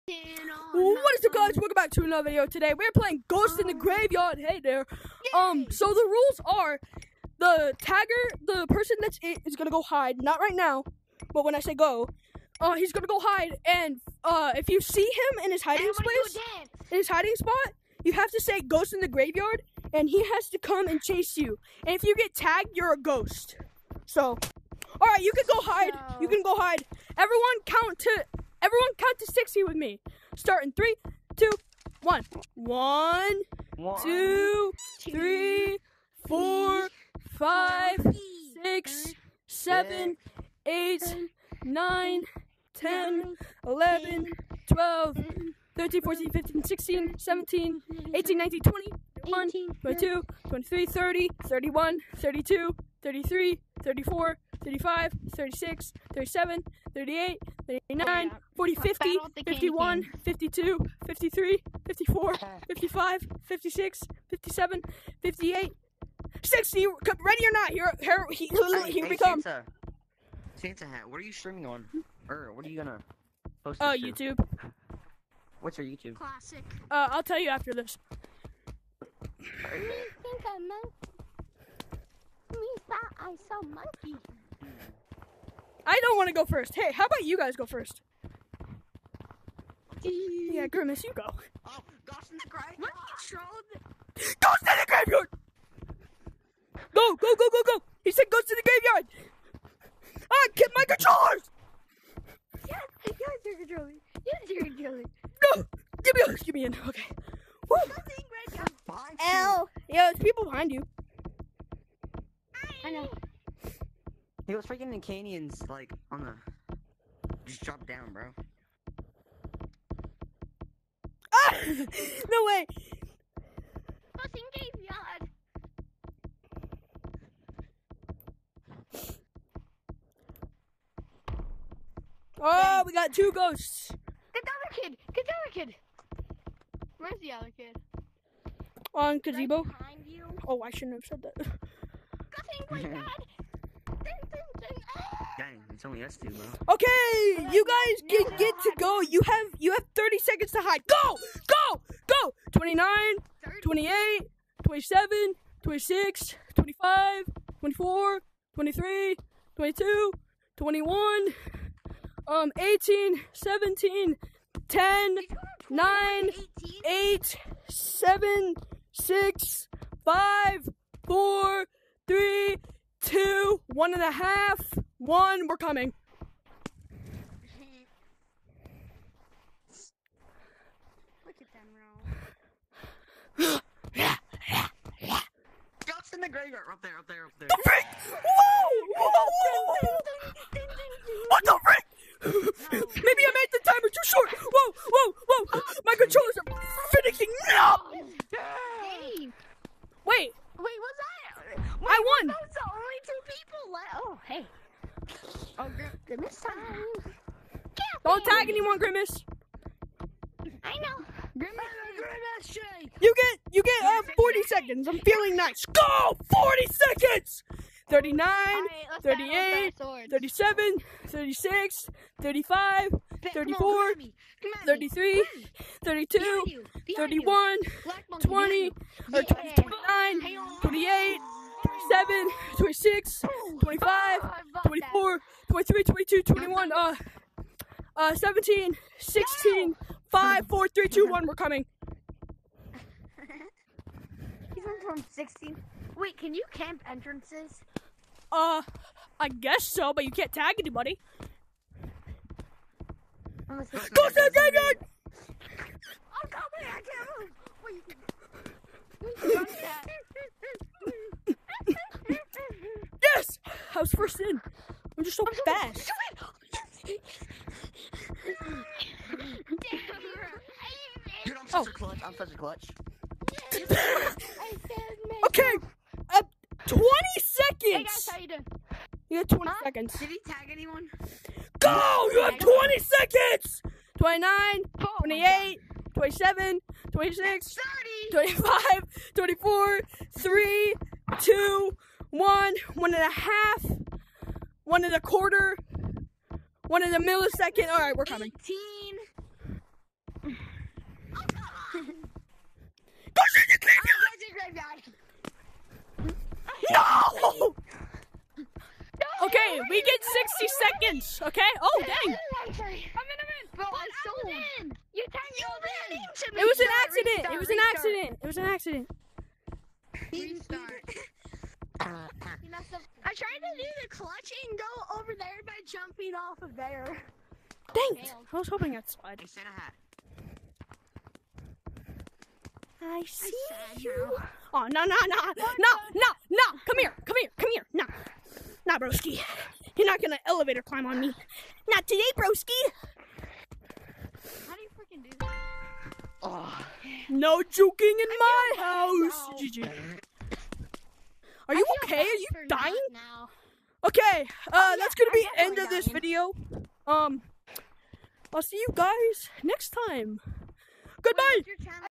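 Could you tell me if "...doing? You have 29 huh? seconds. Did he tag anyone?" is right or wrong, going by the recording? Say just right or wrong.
wrong.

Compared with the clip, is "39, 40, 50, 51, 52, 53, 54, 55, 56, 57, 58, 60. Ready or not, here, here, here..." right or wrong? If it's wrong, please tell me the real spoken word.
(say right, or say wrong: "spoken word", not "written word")
right.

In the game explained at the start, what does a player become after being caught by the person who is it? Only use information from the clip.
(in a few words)
A ghost.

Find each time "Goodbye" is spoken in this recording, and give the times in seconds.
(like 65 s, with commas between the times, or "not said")
361 s.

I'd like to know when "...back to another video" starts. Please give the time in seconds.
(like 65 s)
1 s.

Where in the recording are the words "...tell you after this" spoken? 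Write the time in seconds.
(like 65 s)
77 s.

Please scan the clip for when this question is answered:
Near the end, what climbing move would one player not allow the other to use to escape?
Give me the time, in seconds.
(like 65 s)
340 s.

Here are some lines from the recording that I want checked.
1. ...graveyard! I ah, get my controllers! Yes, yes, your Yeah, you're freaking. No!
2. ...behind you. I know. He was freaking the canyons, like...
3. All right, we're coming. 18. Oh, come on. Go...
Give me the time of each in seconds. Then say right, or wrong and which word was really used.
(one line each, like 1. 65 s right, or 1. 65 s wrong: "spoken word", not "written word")
1. 98 s wrong: "controlling", not "freaking"
2. 110 s right
3. 297 s right.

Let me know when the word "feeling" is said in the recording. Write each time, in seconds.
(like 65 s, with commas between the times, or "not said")
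214 s.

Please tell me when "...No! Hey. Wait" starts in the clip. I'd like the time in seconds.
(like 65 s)
197 s.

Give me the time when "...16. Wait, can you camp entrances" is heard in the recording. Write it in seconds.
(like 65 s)
245 s.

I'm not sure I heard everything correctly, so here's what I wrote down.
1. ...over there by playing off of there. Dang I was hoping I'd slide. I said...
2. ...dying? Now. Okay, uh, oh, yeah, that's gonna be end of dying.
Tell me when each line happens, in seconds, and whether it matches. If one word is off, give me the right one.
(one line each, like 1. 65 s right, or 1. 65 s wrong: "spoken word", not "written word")
1. 324 s wrong: "jumping", not "playing"
2. 352 s right.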